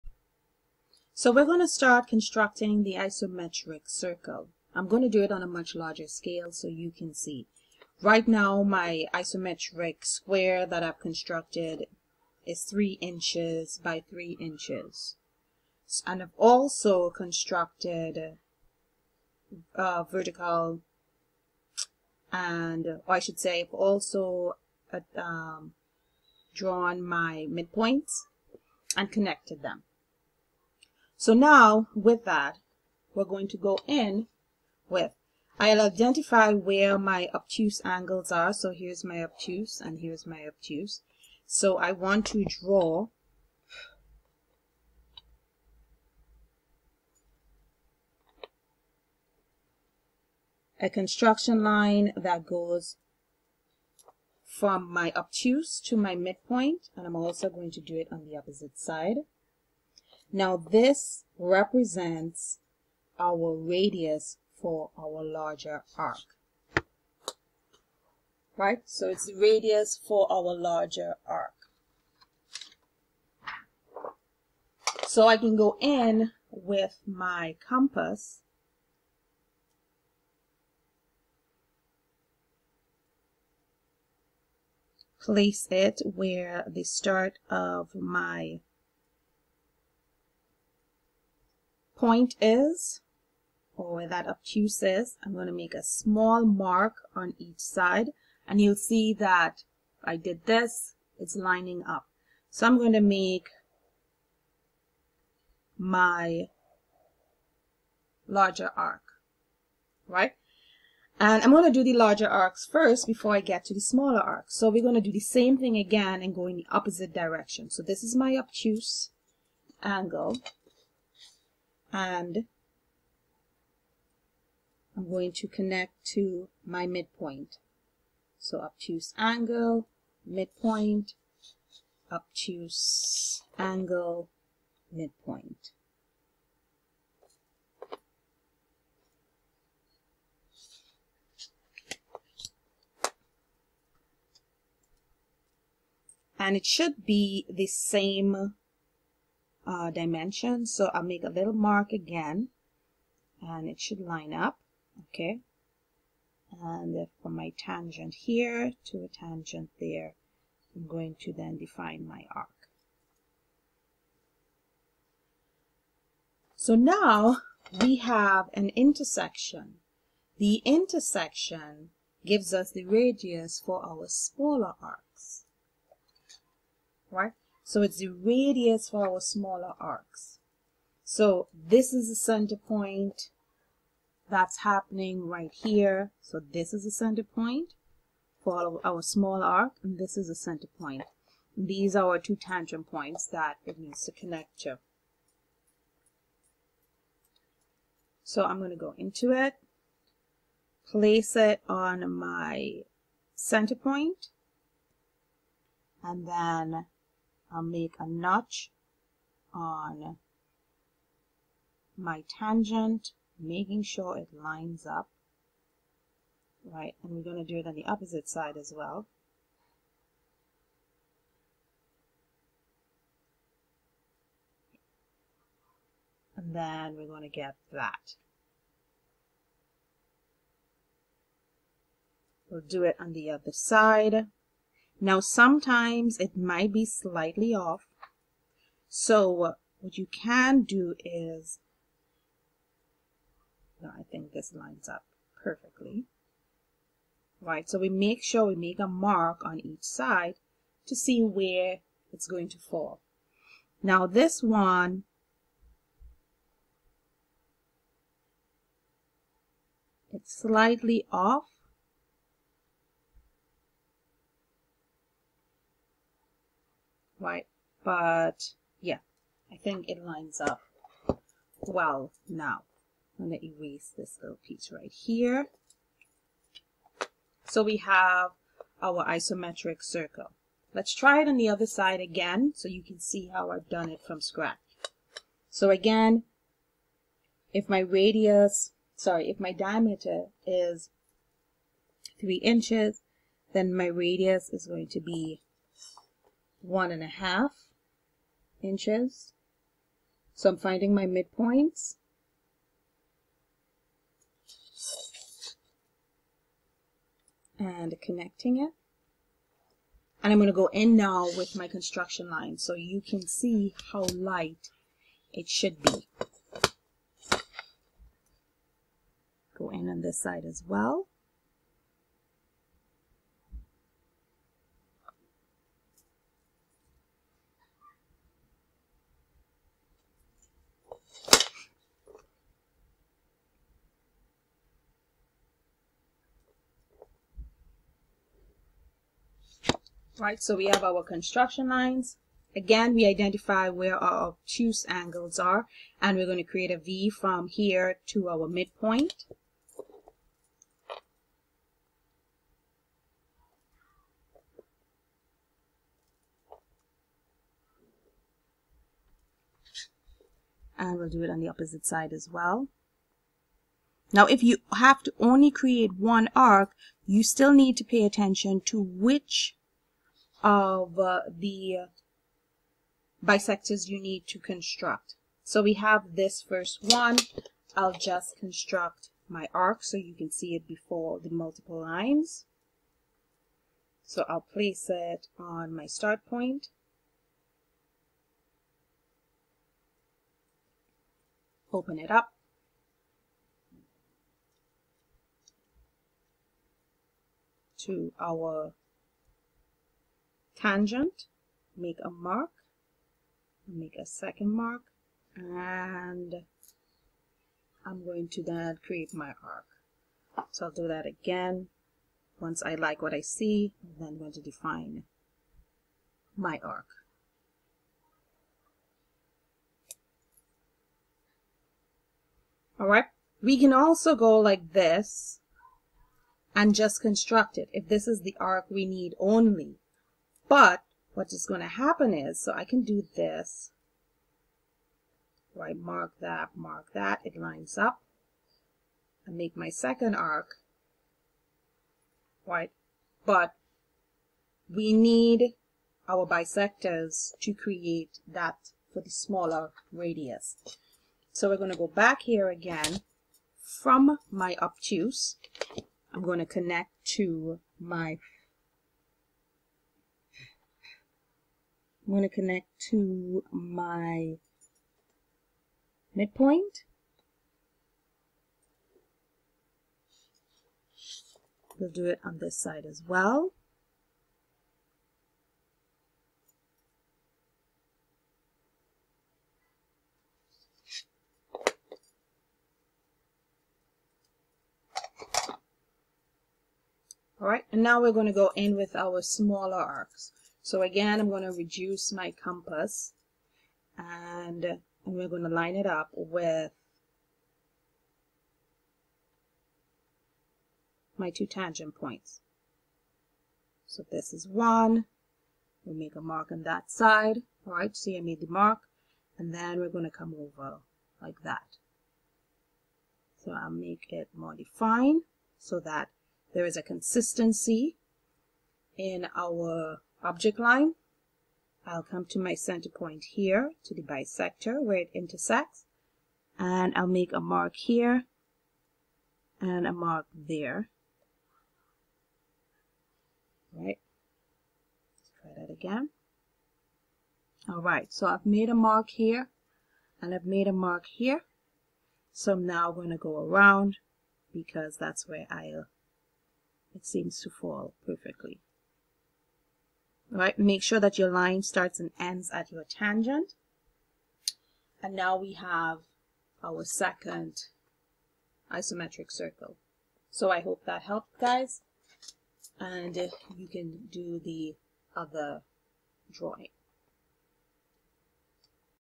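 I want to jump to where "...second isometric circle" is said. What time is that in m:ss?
9:16.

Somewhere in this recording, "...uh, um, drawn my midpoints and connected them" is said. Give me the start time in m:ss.
0:24.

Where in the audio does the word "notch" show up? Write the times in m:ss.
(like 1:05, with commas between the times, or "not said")
3:28.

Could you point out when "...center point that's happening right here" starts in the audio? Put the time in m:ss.
3:02.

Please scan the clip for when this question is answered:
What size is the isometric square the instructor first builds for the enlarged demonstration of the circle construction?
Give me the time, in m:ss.
0:12.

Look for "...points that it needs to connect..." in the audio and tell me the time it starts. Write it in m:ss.
3:12.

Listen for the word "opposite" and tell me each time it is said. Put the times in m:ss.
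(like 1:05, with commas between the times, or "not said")
0:58, 1:56, 3:37, 6:01.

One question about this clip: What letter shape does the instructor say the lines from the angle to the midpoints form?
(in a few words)
V.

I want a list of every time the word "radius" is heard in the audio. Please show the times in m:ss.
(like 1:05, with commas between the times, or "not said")
1:03, 1:09, 2:52, 2:58, 4:47, 4:53, 7:29.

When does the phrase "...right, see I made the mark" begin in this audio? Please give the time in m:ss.
8:27.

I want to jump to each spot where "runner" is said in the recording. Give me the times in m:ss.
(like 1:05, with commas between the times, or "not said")
not said.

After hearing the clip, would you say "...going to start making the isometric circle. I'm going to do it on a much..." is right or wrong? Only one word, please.
wrong.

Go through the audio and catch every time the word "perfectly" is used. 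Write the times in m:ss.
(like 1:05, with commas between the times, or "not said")
4:05, 9:08.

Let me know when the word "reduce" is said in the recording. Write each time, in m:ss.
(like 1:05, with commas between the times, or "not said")
8:11.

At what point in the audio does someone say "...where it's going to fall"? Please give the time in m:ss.
4:11.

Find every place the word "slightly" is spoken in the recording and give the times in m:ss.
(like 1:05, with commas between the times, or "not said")
3:56, 4:20.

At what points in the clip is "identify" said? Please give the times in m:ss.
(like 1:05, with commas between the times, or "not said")
0:35, 5:43.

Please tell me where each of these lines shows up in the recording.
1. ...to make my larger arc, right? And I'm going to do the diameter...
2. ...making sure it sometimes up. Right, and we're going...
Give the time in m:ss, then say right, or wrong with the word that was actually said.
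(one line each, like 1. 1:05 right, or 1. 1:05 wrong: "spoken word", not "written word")
1. 1:42 wrong: "larger", not "diameter"
2. 3:33 wrong: "lines", not "sometimes".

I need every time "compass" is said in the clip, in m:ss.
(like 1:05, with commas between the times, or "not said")
1:17, 8:12.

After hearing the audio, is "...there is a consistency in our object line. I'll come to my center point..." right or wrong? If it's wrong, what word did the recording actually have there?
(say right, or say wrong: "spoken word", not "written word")
right.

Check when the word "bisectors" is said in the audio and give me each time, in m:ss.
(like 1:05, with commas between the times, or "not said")
6:13, 7:26, 8:44.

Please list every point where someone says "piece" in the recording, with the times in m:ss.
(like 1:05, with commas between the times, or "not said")
4:34.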